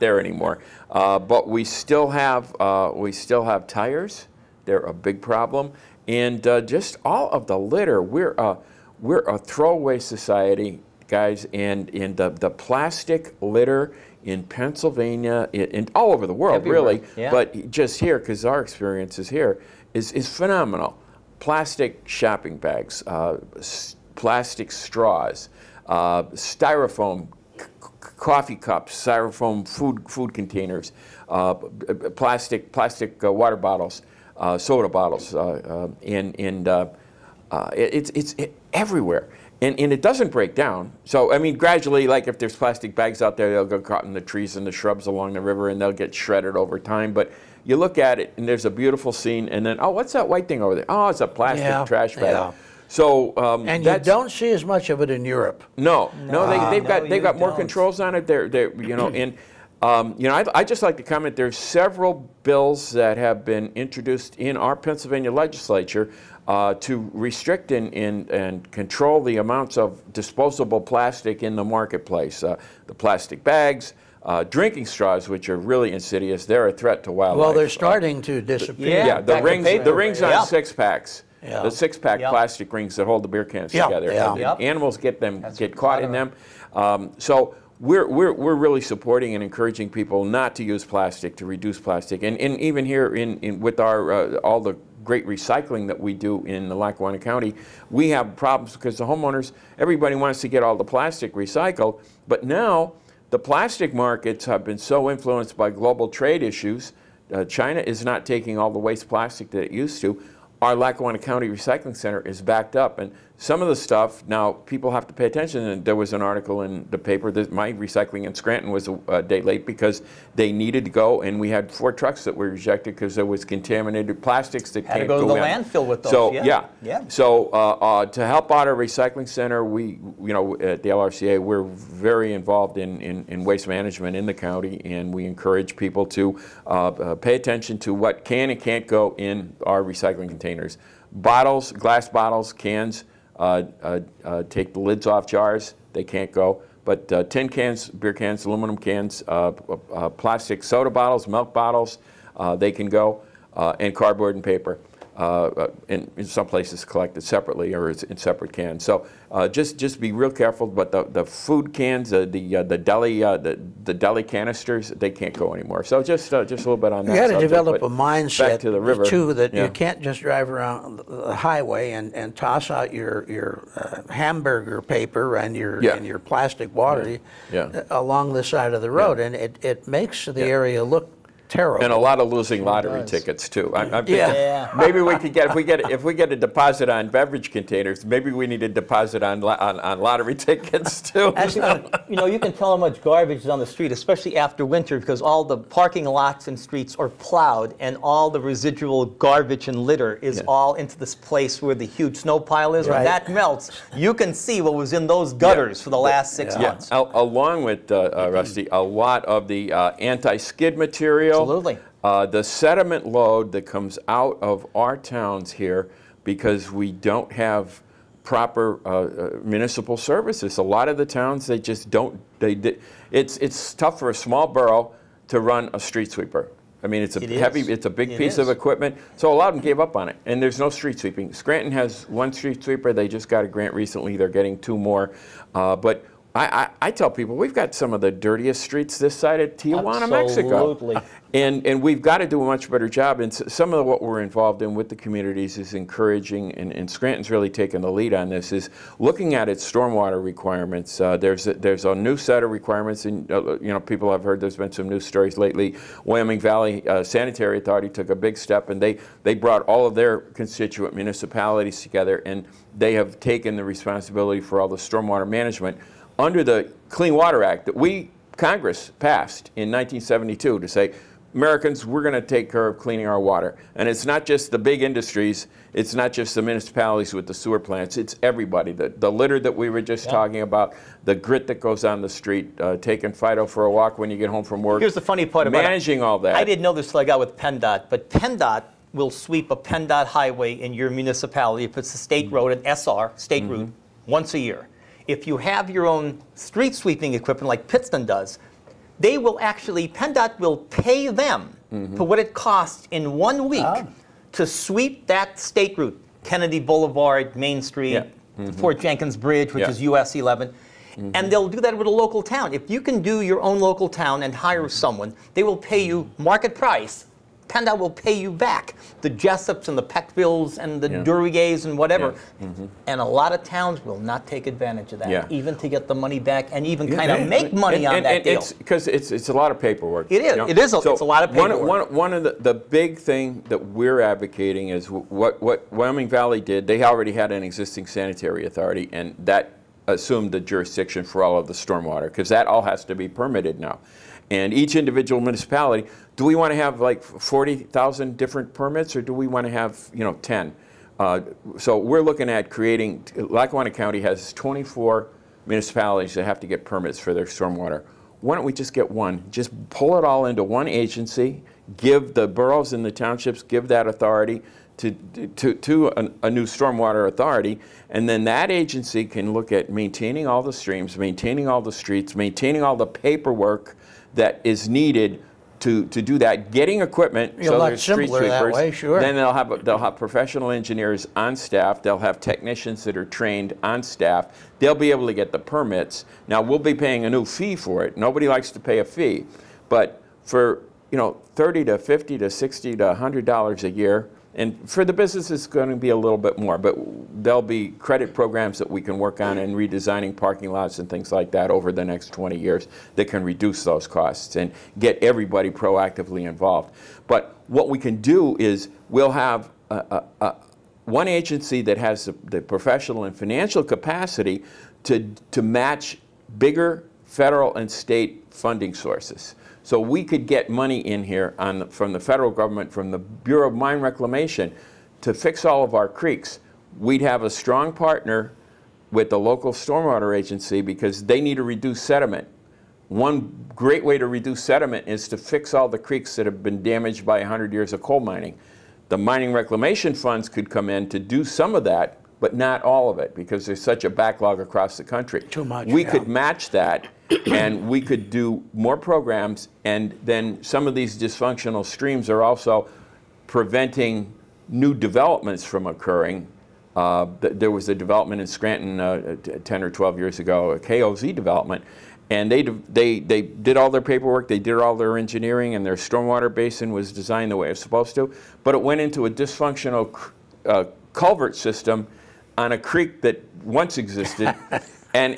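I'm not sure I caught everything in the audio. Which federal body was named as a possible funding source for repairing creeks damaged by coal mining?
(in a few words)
Bureau of Mine Reclamation.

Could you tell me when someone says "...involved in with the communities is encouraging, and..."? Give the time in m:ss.
4:04.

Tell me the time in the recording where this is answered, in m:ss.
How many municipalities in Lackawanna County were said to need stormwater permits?
5:54.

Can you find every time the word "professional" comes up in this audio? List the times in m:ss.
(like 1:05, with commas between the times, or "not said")
6:19, 6:52.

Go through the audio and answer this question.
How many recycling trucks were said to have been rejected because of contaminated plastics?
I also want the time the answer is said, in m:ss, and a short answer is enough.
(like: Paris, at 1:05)
4, at 2:01.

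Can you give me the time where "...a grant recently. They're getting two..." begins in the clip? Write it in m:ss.
3:53.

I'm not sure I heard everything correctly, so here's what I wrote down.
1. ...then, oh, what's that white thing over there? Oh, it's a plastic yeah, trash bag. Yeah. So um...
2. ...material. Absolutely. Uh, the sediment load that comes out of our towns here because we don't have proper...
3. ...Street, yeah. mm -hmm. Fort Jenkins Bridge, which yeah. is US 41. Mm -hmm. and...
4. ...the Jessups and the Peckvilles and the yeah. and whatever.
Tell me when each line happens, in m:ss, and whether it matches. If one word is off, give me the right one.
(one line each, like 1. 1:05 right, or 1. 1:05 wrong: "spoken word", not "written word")
1. 0:49 right
2. 3:30 right
3. 5:07 wrong: "11", not "41"
4. 5:19 right.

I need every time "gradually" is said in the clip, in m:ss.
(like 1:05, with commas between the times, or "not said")
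0:41.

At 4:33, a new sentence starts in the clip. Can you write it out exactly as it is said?
And it's not just the big industries, it's not just the municipalities with the sewer plants, it's everybody.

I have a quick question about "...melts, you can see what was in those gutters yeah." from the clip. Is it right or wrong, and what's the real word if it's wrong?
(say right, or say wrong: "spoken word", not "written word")
right.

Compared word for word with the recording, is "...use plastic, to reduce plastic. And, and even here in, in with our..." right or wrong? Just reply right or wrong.
right.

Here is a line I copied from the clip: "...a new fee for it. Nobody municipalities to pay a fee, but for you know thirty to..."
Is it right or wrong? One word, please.
wrong.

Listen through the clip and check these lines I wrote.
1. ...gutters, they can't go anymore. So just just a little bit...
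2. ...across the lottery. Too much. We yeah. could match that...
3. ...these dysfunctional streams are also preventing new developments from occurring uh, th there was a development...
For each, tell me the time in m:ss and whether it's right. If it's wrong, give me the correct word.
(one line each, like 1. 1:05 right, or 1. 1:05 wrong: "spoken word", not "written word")
1. 2:44 wrong: "canisters", not "gutters"
2. 7:24 wrong: "country", not "lottery"
3. 7:30 right.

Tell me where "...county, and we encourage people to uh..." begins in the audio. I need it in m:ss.
2:14.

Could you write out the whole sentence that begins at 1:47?
Uh, China is not taking all the waste plastic that it used to our Lackawanna County Recycling Center is backed up.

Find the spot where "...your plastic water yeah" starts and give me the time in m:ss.
2:56.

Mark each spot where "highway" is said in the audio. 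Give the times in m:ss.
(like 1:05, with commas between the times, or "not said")
2:51, 4:50.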